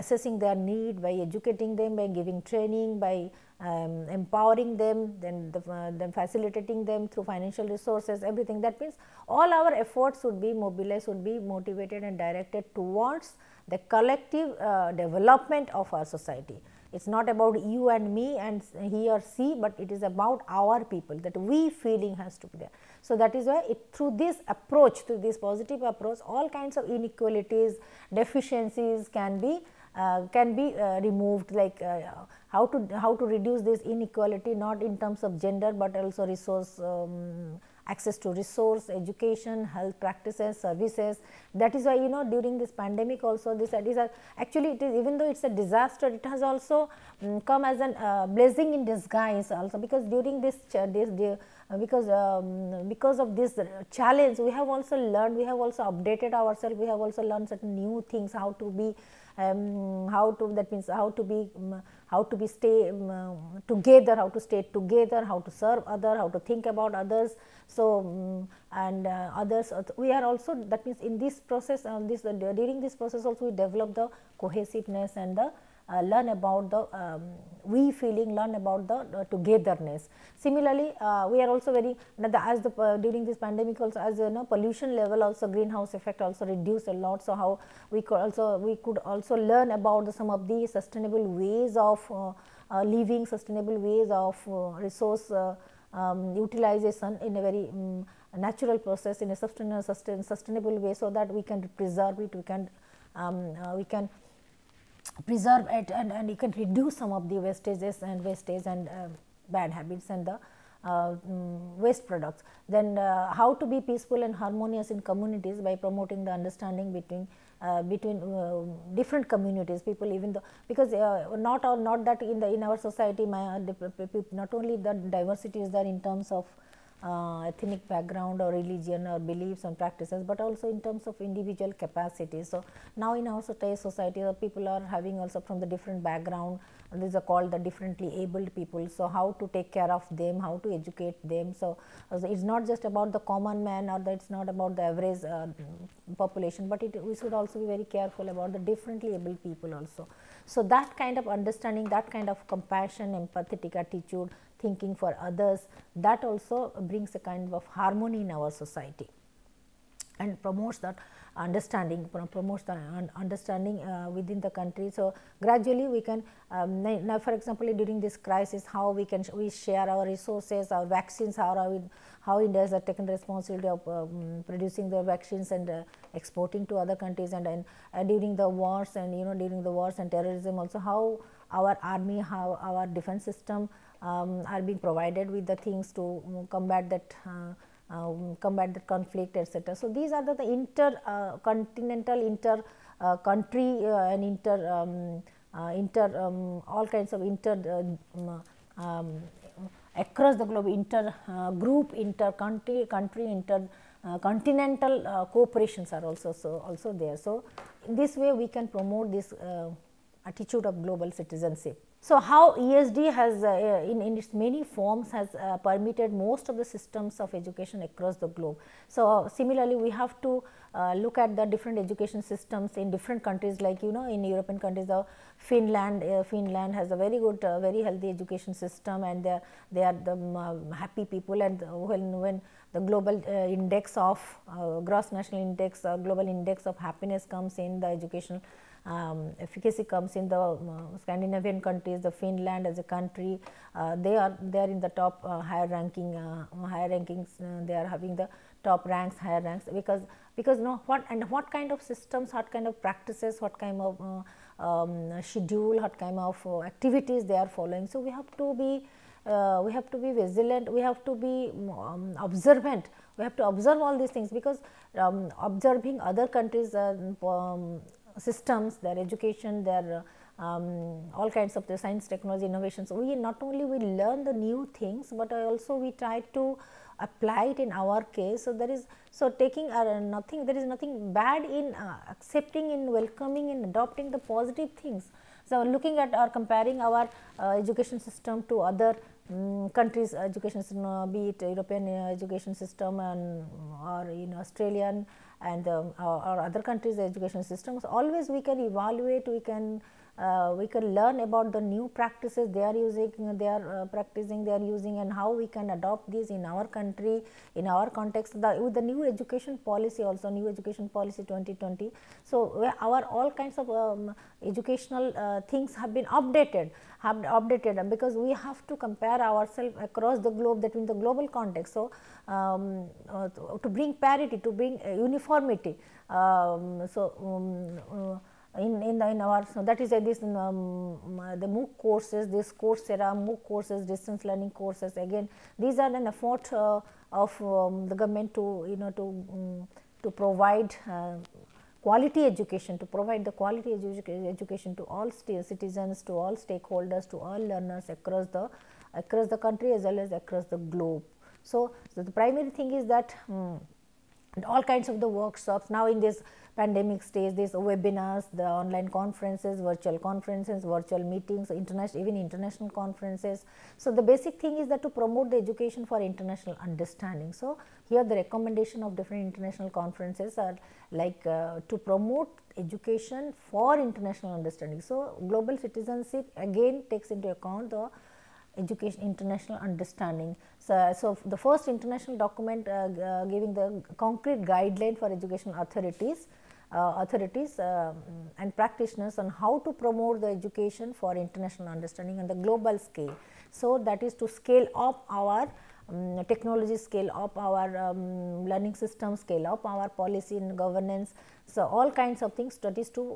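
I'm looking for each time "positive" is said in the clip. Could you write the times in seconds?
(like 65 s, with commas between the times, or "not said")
25 s, 284 s.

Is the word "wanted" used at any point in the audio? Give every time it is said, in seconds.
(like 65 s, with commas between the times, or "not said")
not said.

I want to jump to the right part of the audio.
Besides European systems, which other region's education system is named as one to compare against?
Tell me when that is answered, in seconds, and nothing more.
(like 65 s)
294 s.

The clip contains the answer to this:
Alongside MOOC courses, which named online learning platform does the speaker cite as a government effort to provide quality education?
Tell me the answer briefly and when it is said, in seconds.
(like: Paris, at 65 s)
Coursera, at 332 s.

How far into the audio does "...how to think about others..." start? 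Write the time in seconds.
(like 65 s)
66 s.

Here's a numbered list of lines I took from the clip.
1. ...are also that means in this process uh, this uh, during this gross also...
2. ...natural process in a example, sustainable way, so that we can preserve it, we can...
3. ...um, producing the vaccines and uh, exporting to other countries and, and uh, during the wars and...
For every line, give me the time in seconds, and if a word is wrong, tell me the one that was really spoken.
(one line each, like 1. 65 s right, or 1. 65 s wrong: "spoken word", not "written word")
1. 70 s wrong: "process", not "gross"
2. 98 s wrong: "sustainable", not "example"
3. 173 s right.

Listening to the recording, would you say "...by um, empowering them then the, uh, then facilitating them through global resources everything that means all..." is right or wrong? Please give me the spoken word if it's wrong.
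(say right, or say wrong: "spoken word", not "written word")
wrong: "financial", not "global".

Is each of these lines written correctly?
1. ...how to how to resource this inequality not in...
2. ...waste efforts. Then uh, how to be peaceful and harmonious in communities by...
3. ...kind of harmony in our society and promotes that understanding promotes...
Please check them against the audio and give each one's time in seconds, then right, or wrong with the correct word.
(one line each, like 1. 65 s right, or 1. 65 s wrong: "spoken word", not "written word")
1. 32 s wrong: "reduce", not "resource"
2. 111 s wrong: "products", not "efforts"
3. 157 s right.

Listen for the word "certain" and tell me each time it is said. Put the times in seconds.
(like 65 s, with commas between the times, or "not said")
57 s.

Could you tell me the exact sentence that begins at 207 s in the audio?
So, in this way we can promote this attitude of global citizenship.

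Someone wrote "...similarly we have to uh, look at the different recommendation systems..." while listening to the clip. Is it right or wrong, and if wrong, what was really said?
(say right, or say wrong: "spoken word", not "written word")
wrong: "education", not "recommendation".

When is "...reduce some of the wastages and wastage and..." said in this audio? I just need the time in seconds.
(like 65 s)
106 s.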